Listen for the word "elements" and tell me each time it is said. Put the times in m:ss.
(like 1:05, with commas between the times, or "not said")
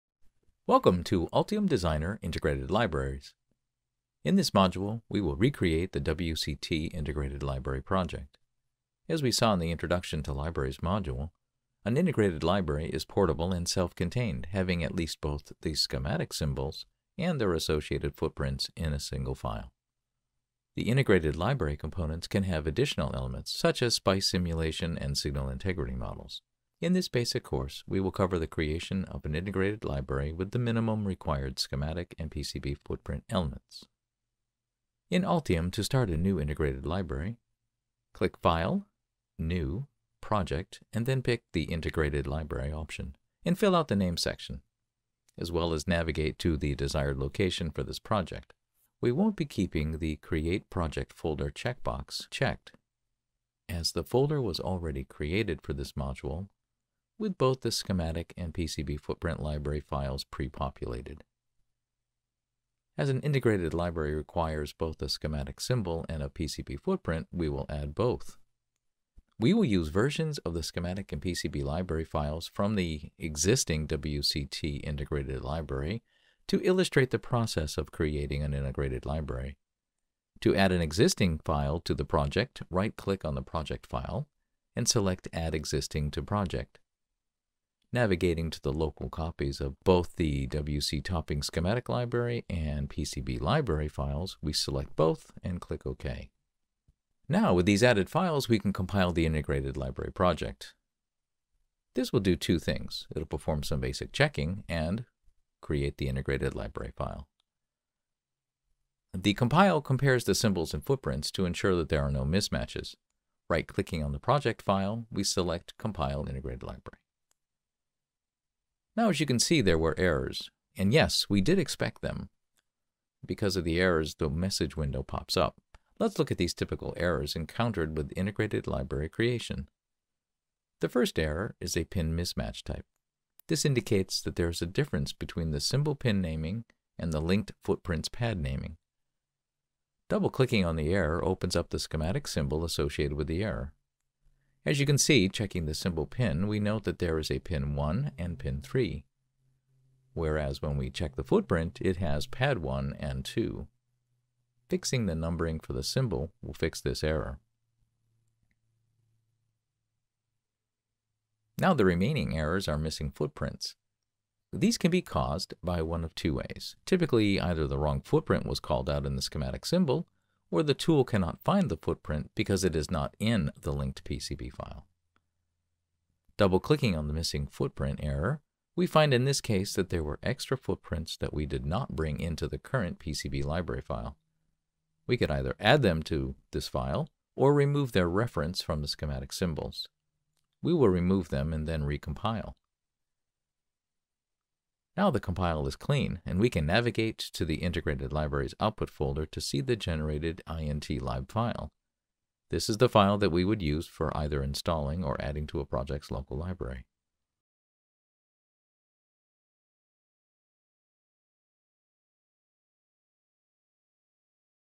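0:23, 0:33.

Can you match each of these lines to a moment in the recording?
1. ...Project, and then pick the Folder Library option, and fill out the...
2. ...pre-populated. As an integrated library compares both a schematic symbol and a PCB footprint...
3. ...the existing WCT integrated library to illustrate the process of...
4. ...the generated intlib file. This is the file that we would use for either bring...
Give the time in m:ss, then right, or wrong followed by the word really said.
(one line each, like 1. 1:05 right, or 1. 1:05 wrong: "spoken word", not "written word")
1. 0:40 wrong: "Integrated", not "Folder"
2. 1:00 wrong: "requires", not "compares"
3. 1:12 right
4. 3:19 wrong: "installing", not "bring".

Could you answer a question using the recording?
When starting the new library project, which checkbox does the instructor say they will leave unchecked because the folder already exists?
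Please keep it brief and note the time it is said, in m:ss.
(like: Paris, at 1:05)
Create Project Folder, at 0:50.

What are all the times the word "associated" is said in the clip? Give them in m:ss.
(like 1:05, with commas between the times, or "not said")
0:17, 2:22.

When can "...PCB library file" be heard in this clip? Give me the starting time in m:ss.
3:02.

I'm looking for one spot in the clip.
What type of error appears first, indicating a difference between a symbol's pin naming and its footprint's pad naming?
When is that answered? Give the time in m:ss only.
2:11.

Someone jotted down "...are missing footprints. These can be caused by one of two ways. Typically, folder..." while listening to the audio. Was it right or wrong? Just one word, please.
wrong.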